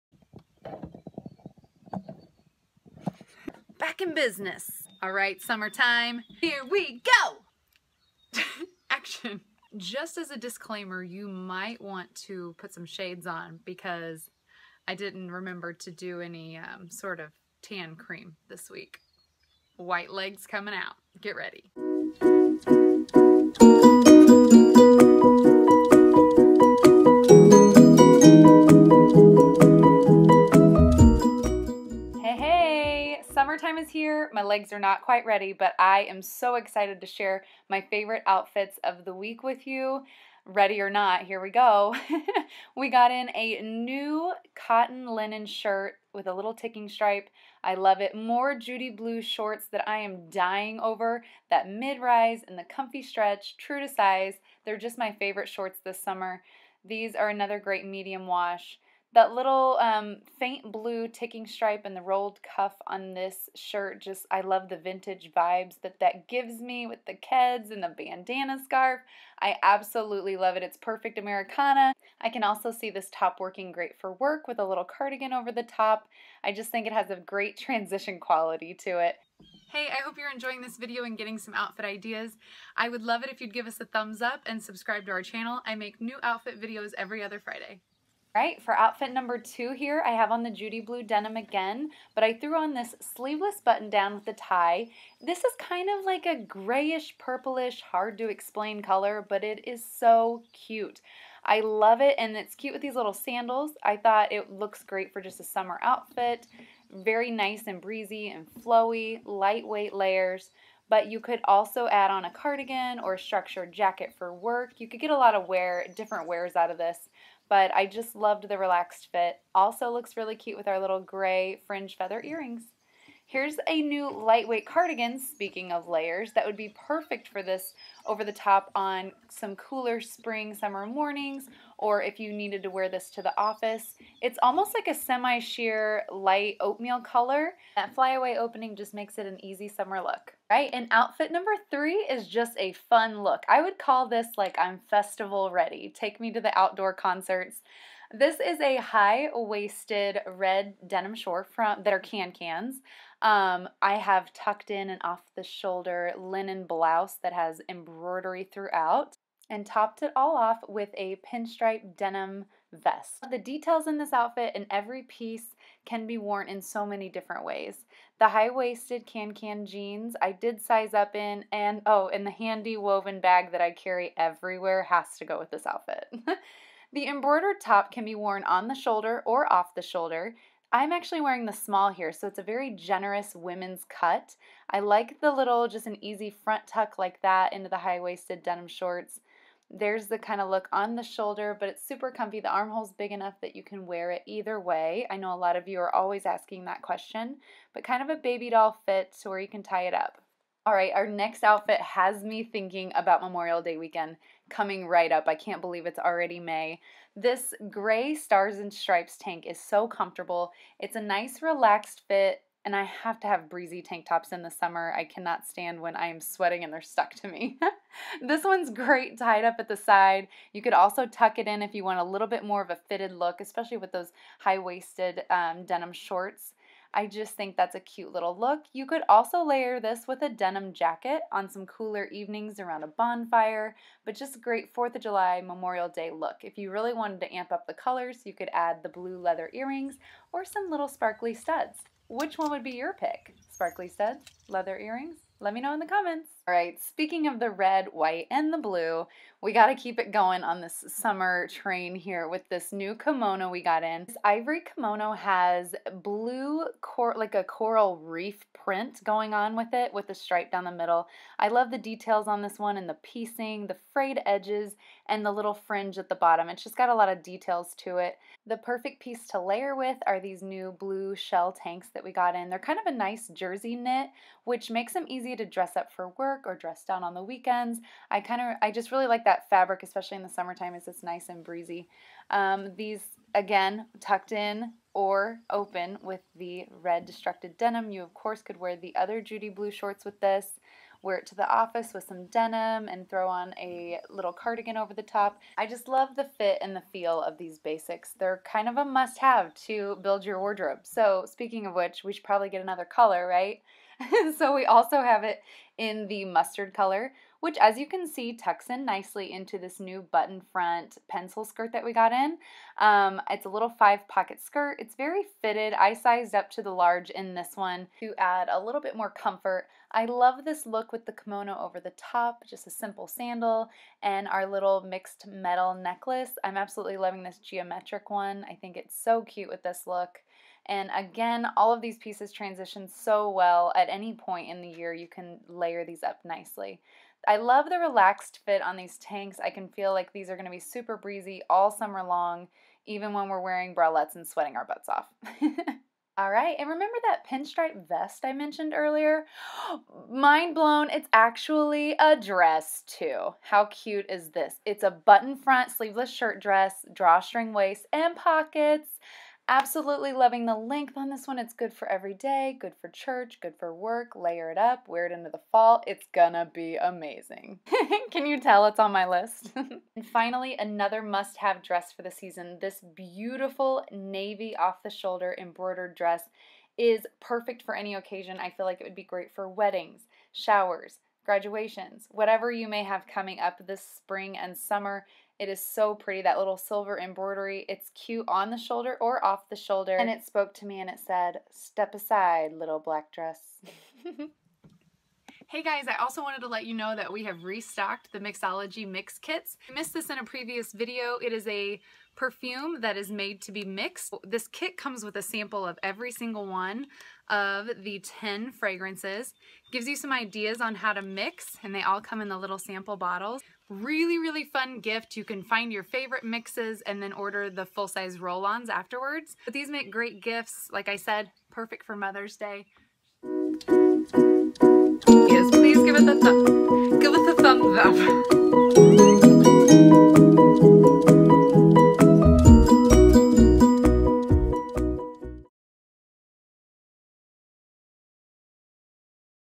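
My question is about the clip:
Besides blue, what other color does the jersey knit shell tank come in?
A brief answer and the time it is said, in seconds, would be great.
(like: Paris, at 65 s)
mustard, at 306 s.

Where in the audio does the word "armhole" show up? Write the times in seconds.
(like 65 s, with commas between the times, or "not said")
192 s.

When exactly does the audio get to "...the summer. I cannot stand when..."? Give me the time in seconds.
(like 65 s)
214 s.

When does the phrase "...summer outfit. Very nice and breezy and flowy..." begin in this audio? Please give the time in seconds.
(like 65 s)
105 s.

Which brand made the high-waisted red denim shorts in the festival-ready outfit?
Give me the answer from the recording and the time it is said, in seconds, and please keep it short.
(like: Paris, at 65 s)
KanCan, at 152 s.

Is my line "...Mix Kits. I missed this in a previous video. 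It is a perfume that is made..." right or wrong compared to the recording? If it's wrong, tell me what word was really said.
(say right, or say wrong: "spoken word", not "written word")
right.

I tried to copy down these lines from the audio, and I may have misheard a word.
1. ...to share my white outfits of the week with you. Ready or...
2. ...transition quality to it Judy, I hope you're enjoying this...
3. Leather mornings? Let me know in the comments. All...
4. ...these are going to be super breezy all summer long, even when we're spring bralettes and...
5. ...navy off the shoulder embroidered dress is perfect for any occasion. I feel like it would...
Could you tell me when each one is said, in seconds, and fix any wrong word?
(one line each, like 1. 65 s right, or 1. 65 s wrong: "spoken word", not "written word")
1. 37 s wrong: "favorite", not "white"
2. 77 s wrong: "Hey", not "Judy"
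3. 244 s wrong: "earrings", not "mornings"
4. 340 s wrong: "wearing", not "spring"
5. 373 s right.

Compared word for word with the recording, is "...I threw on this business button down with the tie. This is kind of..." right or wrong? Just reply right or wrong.
wrong.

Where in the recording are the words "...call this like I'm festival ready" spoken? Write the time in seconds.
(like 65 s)
143 s.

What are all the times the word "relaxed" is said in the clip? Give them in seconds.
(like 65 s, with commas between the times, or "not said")
118 s, 211 s, 337 s.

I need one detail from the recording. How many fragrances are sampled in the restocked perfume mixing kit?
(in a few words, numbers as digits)
10.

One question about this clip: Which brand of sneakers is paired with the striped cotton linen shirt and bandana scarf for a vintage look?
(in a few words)
Keds.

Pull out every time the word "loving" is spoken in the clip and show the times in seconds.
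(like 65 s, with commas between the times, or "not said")
326 s, 360 s.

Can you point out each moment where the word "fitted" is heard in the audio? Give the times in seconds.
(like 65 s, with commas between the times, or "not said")
222 s, 315 s.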